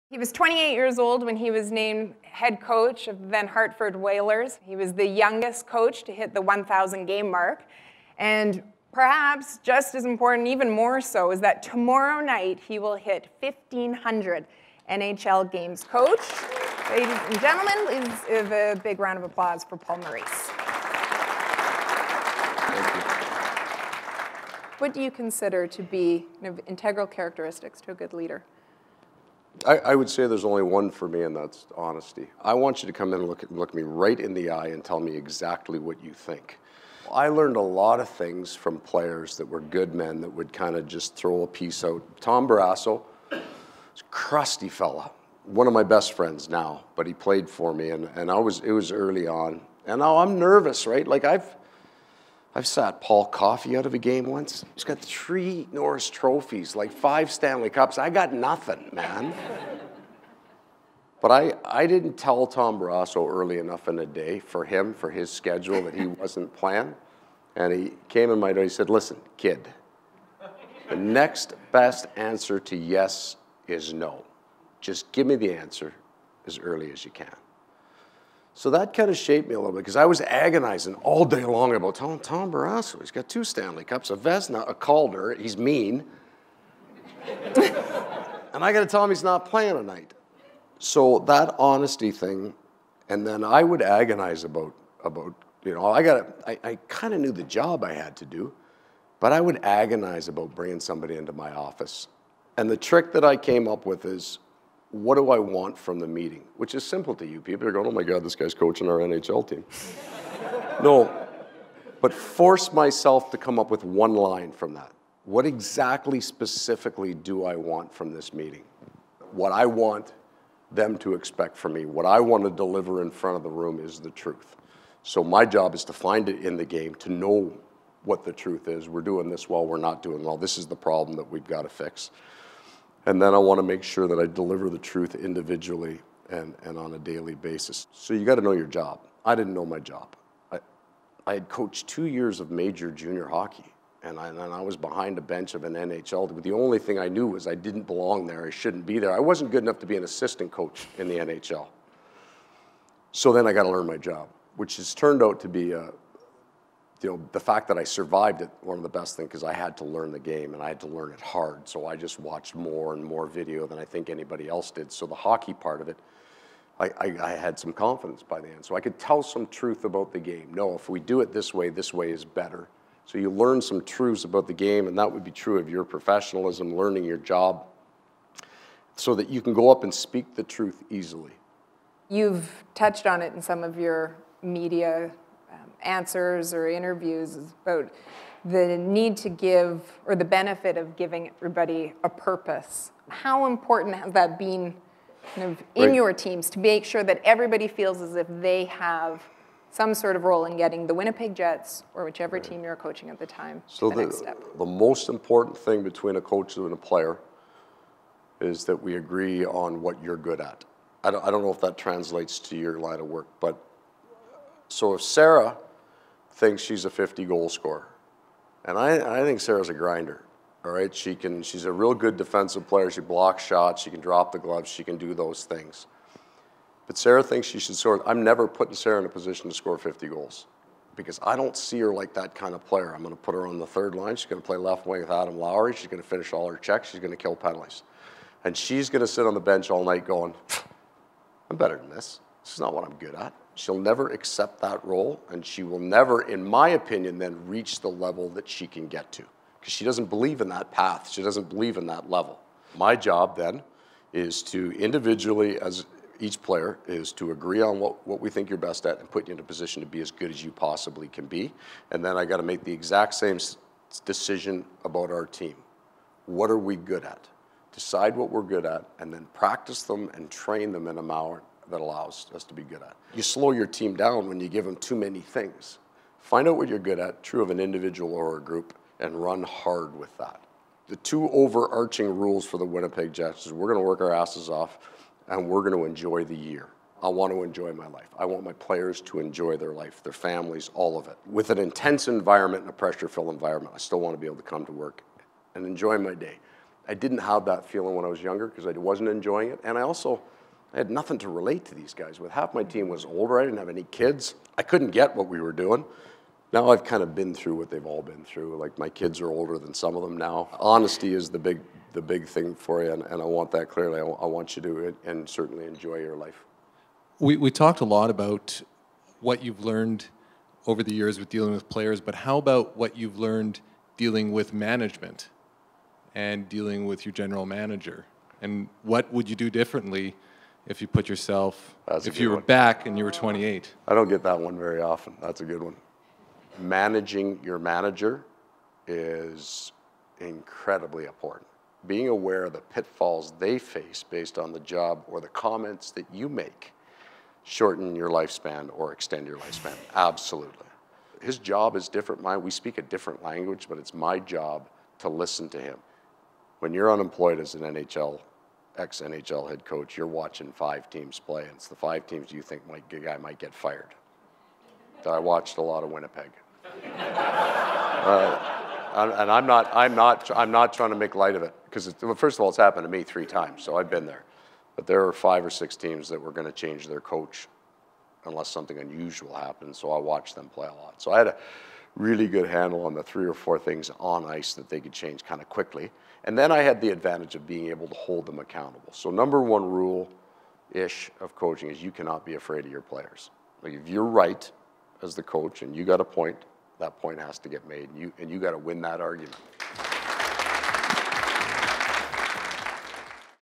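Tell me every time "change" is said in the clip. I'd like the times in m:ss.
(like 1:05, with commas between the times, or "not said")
6:16, 6:24.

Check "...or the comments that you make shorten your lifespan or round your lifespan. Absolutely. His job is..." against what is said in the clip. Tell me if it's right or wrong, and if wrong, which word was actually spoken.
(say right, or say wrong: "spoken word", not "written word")
wrong: "extend", not "round".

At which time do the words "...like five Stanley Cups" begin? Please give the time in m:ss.
0:56.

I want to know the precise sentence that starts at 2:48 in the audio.
So I could tell some truth about the game.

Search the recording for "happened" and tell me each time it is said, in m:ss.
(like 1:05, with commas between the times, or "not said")
6:12, 6:19.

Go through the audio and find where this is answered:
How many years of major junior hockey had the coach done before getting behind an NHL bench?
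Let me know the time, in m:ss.
2:21.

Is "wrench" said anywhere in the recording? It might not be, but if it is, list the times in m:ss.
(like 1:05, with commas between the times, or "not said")
not said.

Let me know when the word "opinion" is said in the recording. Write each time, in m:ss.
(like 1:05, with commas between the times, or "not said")
4:06.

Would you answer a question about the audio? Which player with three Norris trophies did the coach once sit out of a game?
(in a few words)
Paul Coffey.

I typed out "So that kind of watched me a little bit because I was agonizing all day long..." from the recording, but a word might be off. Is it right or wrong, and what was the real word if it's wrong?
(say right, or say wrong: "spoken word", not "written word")
wrong: "shaped", not "watched".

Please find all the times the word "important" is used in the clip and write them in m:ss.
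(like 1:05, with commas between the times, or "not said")
0:10, 3:13, 3:25, 5:41.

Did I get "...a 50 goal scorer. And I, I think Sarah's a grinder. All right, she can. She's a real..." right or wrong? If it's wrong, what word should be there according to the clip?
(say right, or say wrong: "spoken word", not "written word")
right.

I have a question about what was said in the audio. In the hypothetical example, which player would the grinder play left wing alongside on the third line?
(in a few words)
Adam Lowry.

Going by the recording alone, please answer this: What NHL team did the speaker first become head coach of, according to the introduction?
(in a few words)
Hartford Whalers.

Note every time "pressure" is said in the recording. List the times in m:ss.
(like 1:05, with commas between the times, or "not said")
4:52.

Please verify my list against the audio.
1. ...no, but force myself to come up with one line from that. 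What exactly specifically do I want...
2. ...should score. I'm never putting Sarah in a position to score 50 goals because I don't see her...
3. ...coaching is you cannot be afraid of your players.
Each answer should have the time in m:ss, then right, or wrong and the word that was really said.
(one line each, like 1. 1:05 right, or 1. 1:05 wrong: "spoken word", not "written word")
1. 1:50 right
2. 3:47 right
3. 6:31 right.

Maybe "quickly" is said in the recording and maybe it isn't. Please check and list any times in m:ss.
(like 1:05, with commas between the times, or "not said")
6:25.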